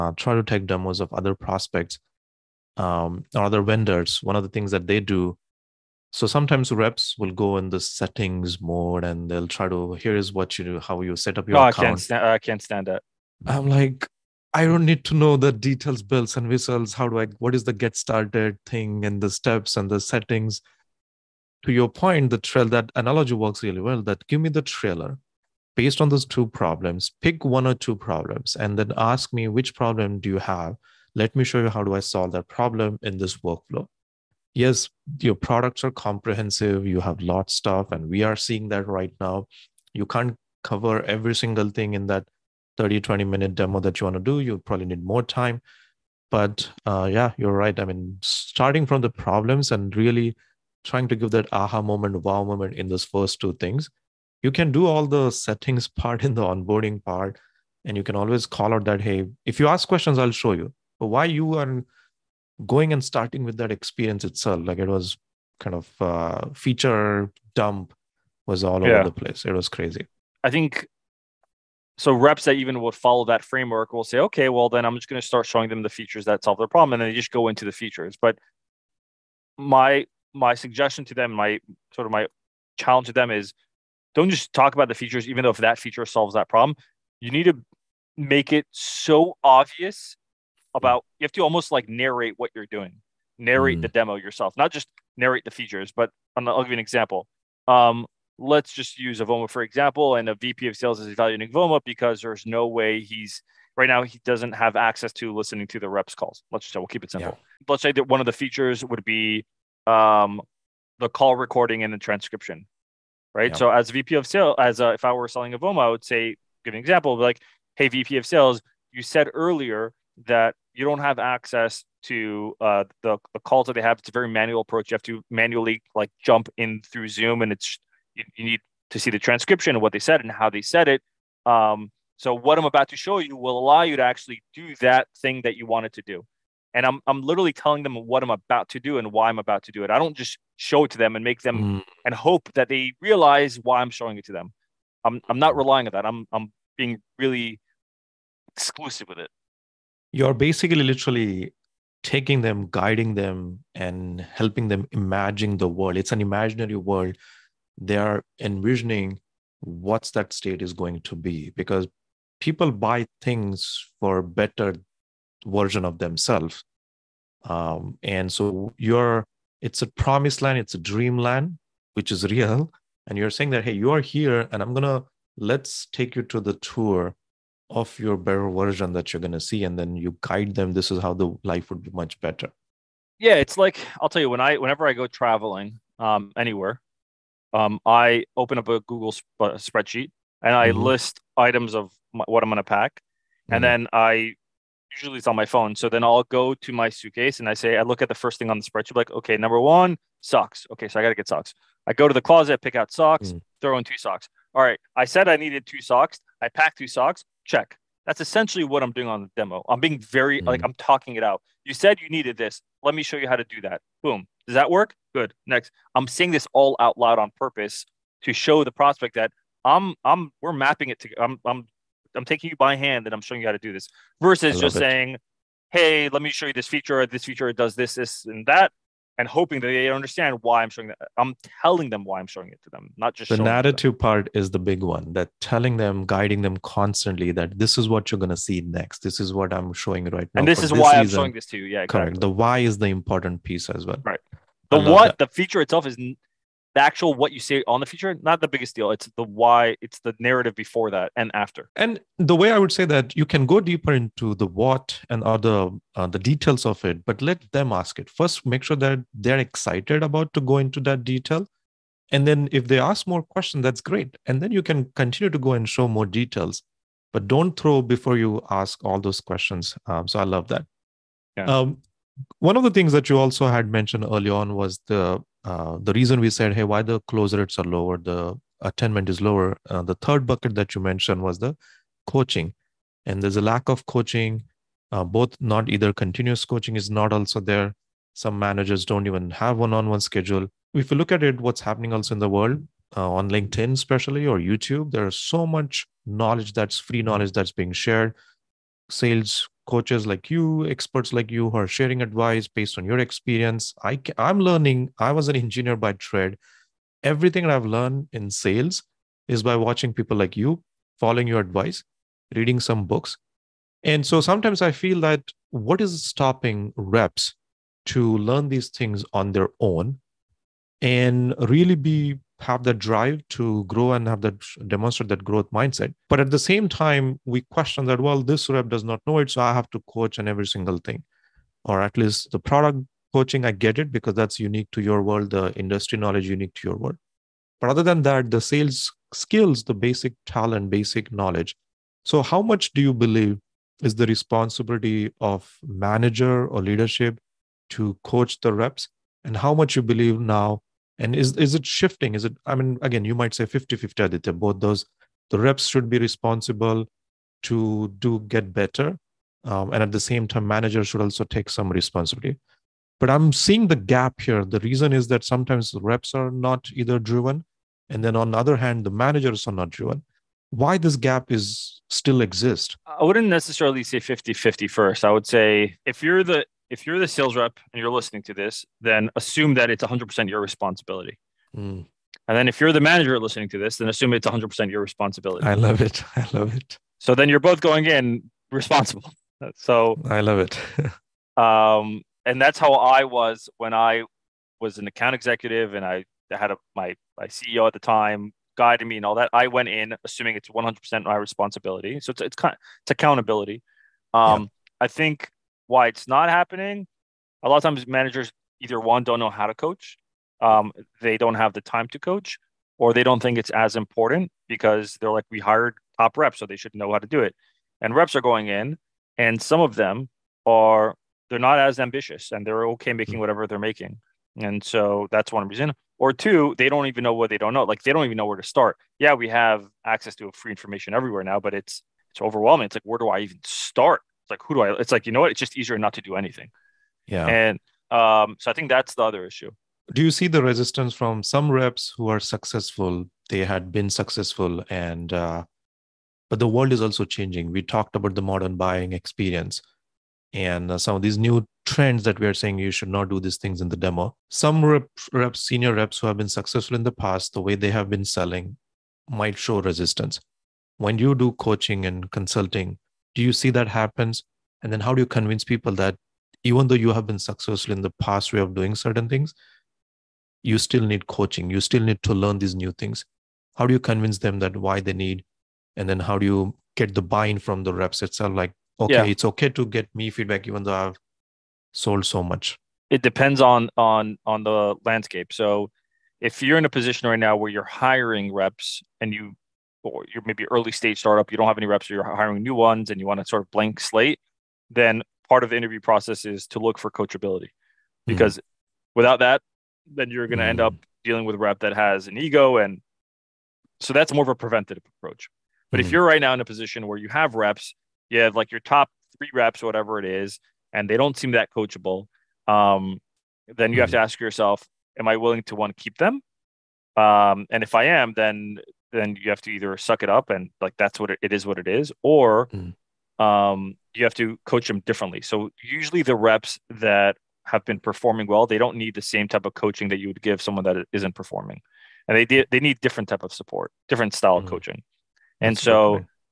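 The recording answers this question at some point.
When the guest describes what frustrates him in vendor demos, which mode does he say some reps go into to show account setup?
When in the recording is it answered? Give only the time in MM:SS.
00:07.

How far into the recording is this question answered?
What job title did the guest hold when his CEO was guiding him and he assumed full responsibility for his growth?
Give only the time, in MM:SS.
06:34.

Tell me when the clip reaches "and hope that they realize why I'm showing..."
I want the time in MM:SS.
02:22.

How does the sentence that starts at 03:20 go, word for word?
Okay, so I got to get socks.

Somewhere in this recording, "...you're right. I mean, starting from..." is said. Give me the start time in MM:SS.
00:47.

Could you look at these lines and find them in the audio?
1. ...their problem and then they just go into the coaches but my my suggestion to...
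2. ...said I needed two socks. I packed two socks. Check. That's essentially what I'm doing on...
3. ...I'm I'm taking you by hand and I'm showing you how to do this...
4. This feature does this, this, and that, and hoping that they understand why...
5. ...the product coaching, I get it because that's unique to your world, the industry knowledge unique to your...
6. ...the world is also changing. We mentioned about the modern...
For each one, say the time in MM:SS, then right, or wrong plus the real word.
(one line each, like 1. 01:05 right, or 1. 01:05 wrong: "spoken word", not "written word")
1. 01:16 wrong: "features", not "coaches"
2. 03:25 right
3. 03:41 right
4. 03:47 right
5. 05:32 right
6. 07:26 wrong: "talked", not "mentioned".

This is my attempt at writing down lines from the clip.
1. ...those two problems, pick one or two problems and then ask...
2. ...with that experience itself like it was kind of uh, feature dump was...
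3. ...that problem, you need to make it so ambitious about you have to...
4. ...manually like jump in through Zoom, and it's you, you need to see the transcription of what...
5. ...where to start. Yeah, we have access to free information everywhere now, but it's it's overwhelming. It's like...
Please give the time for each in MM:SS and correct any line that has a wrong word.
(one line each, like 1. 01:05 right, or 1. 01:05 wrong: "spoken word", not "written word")
1. 00:26 right
2. 01:03 right
3. 01:26 wrong: "obvious", not "ambitious"
4. 02:05 right
5. 07:08 right.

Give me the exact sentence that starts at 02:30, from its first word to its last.
You're basically literally taking them, guiding them, and helping them imagine the world.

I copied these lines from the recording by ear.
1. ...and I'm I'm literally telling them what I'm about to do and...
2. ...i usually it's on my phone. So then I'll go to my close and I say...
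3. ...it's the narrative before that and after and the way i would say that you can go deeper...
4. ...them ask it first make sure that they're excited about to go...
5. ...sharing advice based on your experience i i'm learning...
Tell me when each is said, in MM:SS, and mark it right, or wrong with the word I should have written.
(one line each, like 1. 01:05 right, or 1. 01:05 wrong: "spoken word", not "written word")
1. 02:16 right
2. 03:13 wrong: "suitcase", not "close"
3. 04:09 right
4. 04:17 right
5. 05:01 right.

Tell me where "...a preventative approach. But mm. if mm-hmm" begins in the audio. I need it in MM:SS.
08:24.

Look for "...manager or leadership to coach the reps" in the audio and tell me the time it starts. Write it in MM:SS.
05:45.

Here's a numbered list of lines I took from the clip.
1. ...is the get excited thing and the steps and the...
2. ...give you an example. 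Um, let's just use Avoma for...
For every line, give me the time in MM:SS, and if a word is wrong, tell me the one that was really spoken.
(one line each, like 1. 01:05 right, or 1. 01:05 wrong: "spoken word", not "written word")
1. 00:17 wrong: "started", not "excited"
2. 01:36 right.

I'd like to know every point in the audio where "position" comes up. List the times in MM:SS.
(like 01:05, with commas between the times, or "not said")
08:06, 08:26.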